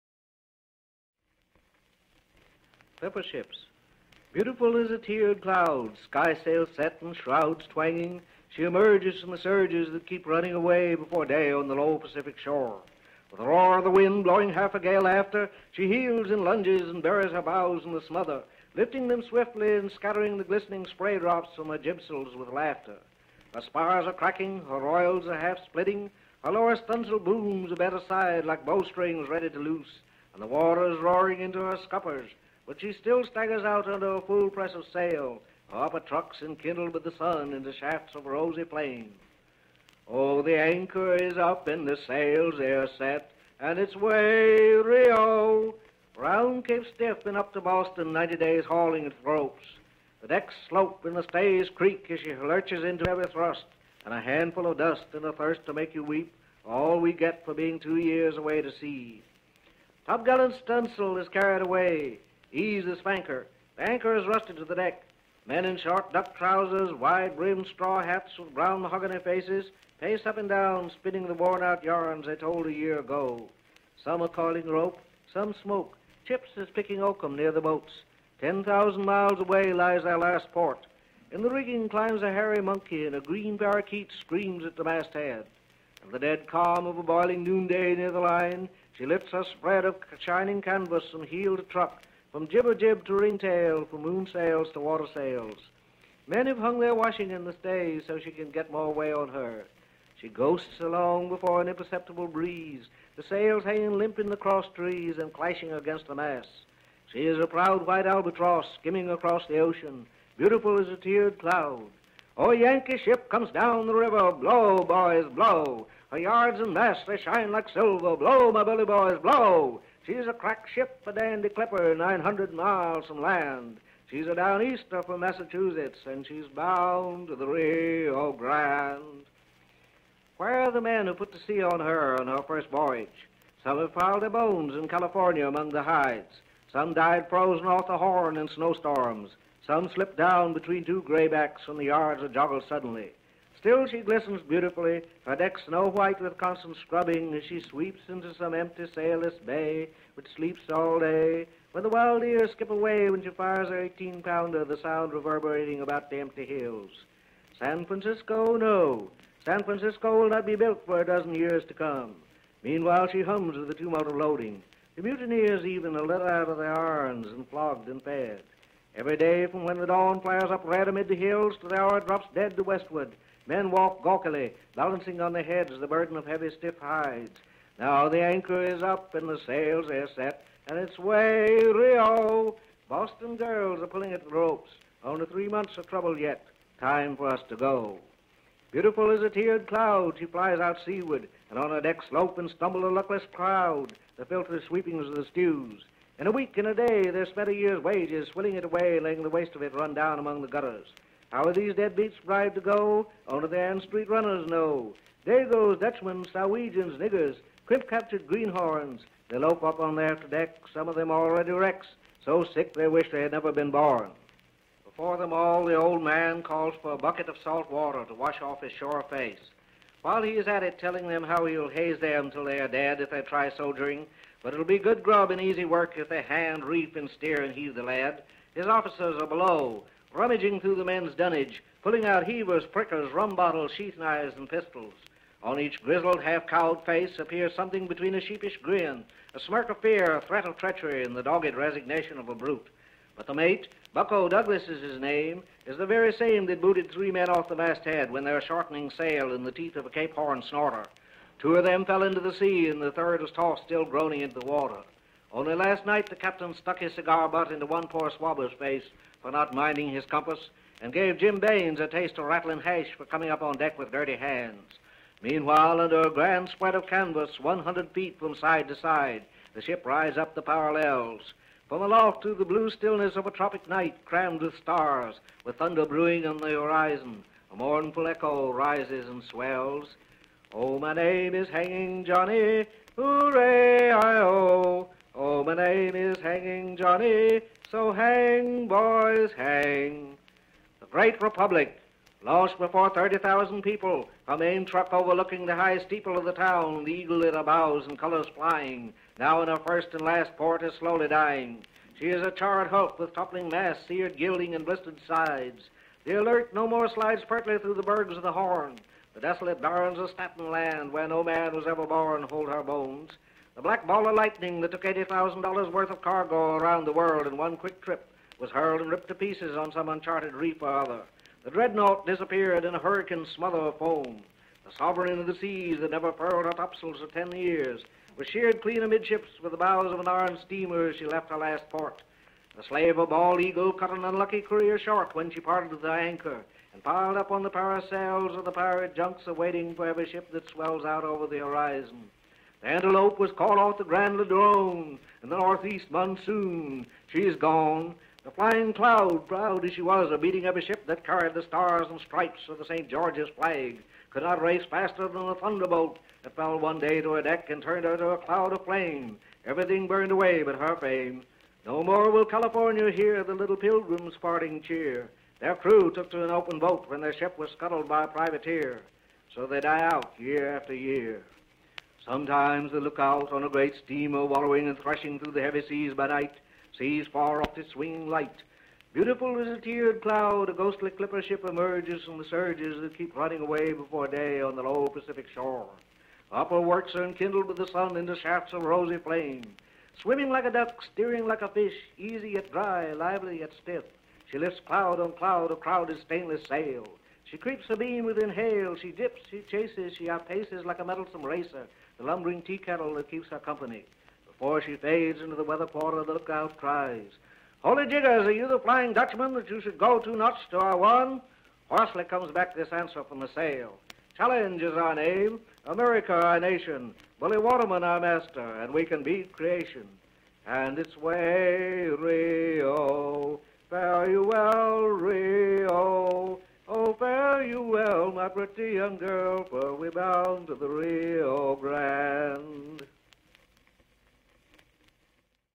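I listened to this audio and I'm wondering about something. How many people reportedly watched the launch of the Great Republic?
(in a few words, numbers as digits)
30,000.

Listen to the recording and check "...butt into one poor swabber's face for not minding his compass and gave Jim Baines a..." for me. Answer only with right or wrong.
right.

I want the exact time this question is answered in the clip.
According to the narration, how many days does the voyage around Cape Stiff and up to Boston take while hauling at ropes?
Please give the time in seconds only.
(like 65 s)
48 s.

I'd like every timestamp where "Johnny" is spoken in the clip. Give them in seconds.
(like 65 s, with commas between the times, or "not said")
282 s, 286 s.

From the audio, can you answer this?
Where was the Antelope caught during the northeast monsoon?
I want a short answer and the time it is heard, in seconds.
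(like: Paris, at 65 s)
Grand Ladrone, at 343 s.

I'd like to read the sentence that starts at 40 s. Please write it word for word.
Oh, the anchor is up and the sails are set, and it's way Rio.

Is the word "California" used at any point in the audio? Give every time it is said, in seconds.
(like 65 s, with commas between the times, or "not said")
134 s, 362 s.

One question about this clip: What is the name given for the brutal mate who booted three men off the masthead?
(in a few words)
Bucko Douglas.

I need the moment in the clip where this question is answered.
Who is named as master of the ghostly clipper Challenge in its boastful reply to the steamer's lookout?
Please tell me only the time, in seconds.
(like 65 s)
417 s.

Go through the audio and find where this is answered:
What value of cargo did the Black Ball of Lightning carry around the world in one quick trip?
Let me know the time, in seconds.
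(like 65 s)
314 s.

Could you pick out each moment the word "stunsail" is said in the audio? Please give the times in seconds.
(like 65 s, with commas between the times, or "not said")
26 s, 60 s.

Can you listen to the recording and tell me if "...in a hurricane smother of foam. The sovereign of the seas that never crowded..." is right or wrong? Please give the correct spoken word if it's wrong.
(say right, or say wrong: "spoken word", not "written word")
wrong: "furled", not "crowded".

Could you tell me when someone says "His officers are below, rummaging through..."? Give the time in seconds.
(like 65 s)
228 s.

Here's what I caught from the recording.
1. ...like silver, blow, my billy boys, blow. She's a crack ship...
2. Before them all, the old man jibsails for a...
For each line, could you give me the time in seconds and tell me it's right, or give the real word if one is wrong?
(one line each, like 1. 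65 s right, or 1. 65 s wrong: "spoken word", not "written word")
1. 117 s right
2. 214 s wrong: "calls", not "jibsails".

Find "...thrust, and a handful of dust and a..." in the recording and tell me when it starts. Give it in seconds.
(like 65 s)
53 s.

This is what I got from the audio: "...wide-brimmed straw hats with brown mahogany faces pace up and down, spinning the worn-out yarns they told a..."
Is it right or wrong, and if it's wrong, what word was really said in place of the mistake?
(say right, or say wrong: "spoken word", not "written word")
right.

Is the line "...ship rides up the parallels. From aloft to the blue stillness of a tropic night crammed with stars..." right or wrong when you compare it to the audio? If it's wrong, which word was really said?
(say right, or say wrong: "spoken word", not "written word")
right.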